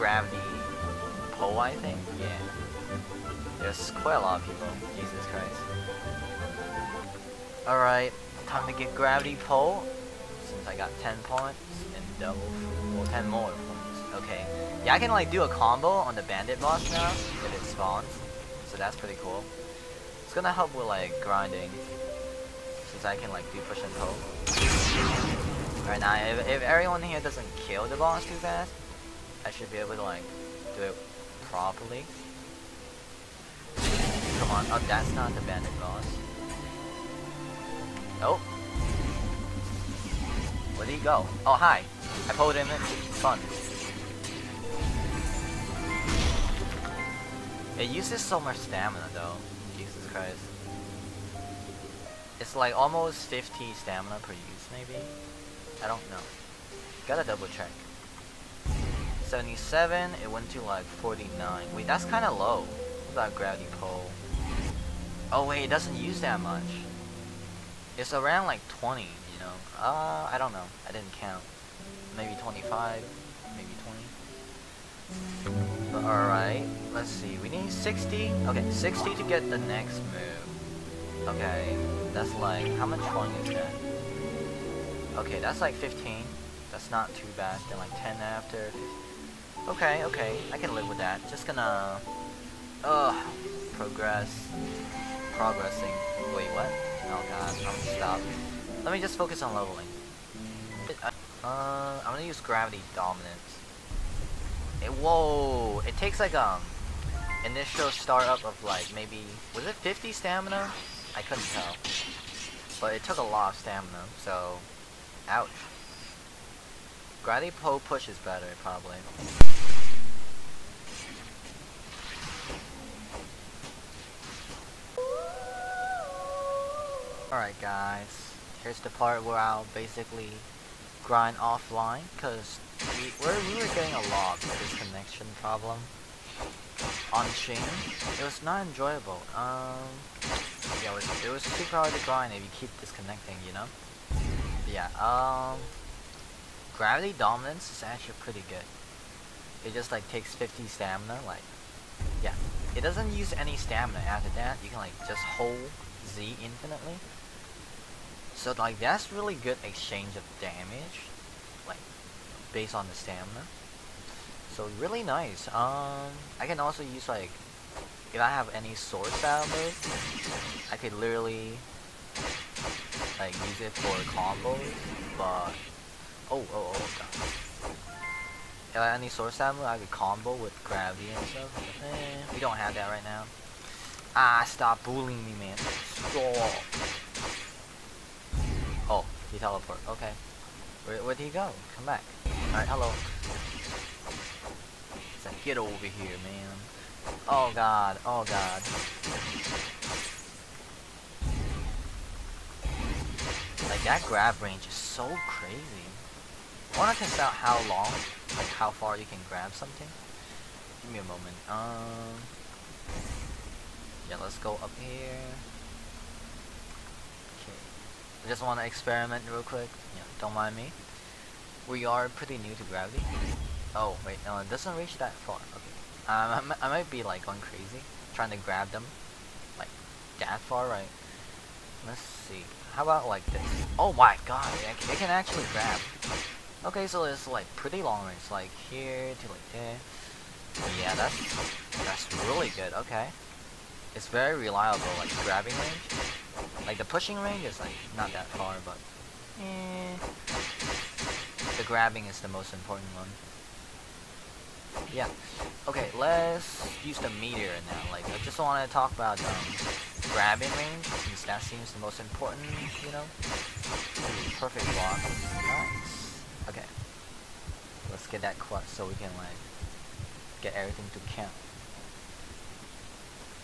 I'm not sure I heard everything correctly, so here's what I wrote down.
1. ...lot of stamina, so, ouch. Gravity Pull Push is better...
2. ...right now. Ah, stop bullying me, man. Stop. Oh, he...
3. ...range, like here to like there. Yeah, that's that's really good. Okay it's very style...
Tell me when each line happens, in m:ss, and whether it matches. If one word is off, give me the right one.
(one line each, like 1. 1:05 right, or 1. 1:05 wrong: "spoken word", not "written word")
1. 1:53 right
2. 3:02 right
3. 3:58 wrong: "reliable", not "style".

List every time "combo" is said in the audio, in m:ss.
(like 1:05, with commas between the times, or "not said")
0:15, 2:54, 2:59.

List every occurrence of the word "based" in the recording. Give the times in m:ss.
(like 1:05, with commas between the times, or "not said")
2:42.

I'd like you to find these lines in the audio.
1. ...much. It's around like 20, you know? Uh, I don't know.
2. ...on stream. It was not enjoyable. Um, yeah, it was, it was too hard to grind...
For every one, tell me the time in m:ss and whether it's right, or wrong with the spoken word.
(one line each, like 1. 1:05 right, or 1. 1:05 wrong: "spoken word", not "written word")
1. 1:06 right
2. 2:17 right.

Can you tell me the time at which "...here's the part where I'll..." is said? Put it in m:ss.
2:08.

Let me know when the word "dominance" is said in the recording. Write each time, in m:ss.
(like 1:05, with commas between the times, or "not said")
1:42, 2:27.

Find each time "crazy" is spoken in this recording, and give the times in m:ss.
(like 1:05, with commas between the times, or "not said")
3:25, 3:47.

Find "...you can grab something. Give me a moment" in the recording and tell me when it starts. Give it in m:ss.
3:28.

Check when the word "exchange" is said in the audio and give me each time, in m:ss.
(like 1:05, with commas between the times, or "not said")
2:39.